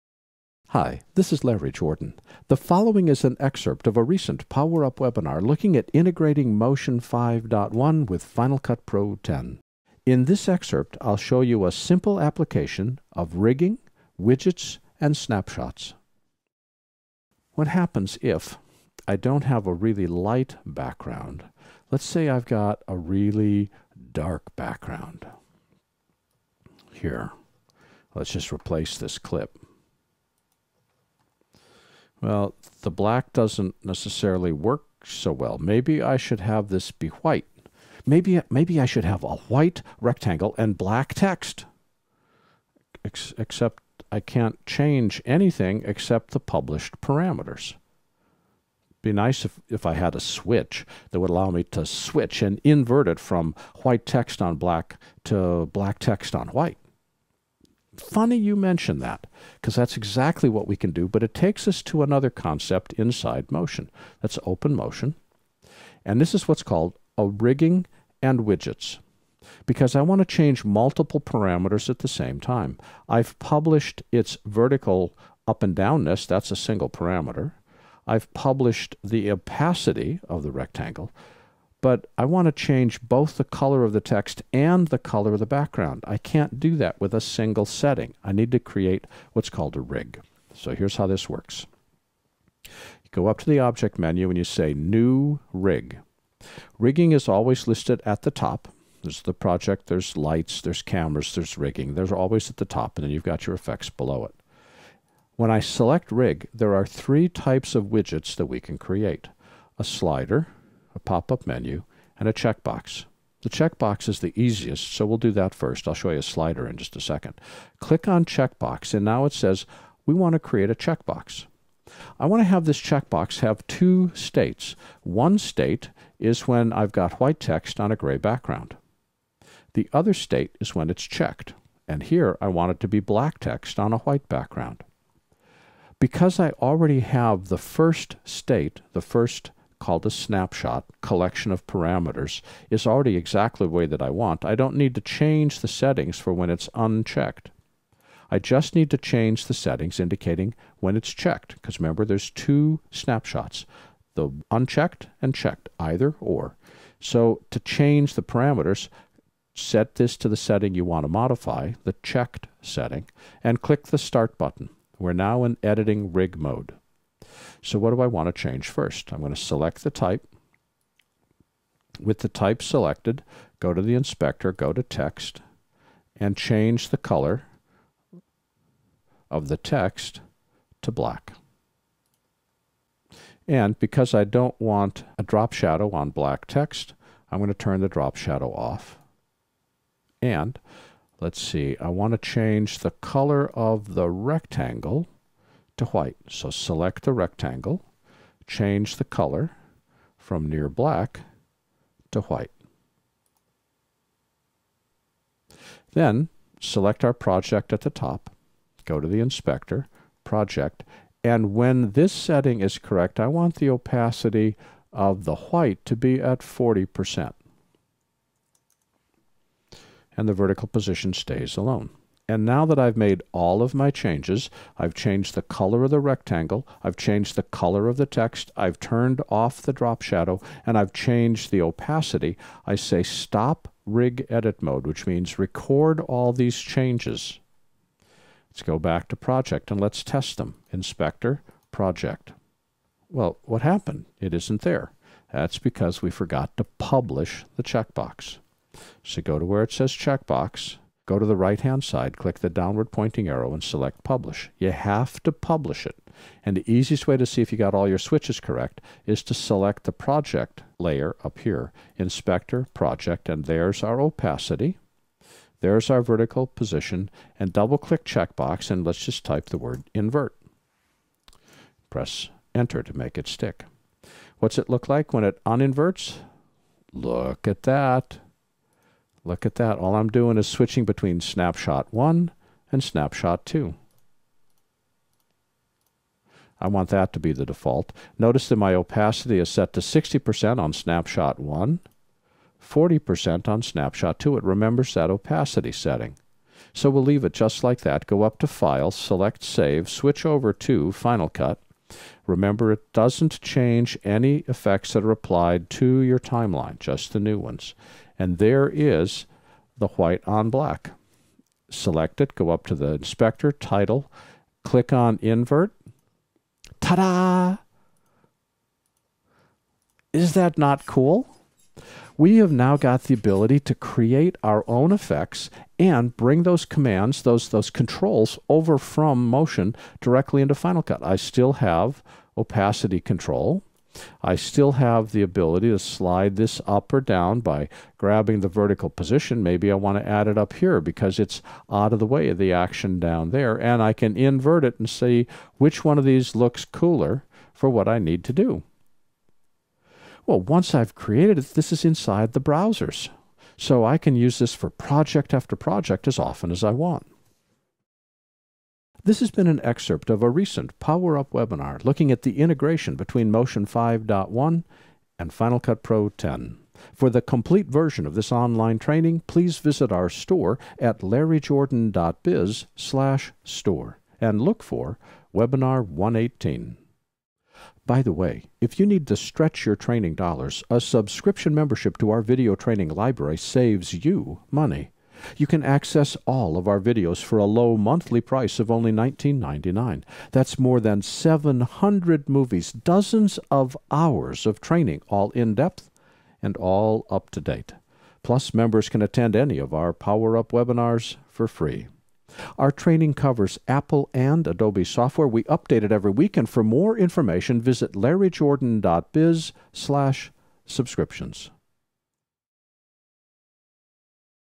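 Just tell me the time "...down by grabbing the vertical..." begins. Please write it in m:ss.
5:37.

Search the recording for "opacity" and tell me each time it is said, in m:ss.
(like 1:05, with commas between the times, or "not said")
1:19, 3:33, 3:51, 4:23, 4:48, 4:55, 5:32.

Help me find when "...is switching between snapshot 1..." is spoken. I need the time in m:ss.
4:40.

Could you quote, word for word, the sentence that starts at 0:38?
Maybe, maybe I should have a white rectangle and black text.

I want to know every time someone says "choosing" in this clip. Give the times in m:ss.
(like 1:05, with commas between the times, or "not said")
not said.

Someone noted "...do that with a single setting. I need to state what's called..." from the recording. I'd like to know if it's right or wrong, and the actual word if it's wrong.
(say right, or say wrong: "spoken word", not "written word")
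wrong: "create", not "state".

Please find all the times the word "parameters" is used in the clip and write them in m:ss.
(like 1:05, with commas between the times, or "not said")
0:47, 1:11, 1:16, 2:21, 2:38.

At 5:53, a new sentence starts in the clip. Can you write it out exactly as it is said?
So I can use this for project after project as often as I want.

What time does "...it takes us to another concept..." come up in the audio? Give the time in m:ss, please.
1:01.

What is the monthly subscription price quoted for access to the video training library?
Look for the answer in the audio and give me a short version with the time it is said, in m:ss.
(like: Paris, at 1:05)
$19.99, at 6:28.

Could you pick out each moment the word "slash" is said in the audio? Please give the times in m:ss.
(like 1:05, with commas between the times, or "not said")
6:12, 6:49.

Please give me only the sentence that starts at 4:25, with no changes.
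There's our vertical position, and double-click checkbox, and let's just type the word Invert.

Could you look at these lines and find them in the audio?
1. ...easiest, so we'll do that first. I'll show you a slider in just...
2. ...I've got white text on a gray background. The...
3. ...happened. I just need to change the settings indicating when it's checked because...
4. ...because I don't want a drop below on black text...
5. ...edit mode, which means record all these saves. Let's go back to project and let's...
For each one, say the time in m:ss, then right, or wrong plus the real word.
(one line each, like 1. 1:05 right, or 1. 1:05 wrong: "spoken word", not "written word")
1. 1:54 right
2. 2:06 right
3. 2:26 wrong: "unchecked", not "happened"
4. 3:03 wrong: "shadow", not "below"
5. 3:54 wrong: "changes", not "saves".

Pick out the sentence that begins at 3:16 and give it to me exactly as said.
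So select the rectangle, change the color from near black to white.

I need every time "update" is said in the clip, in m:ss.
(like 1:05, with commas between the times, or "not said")
6:45.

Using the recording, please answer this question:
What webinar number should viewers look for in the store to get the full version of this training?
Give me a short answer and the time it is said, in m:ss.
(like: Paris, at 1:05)
118, at 6:15.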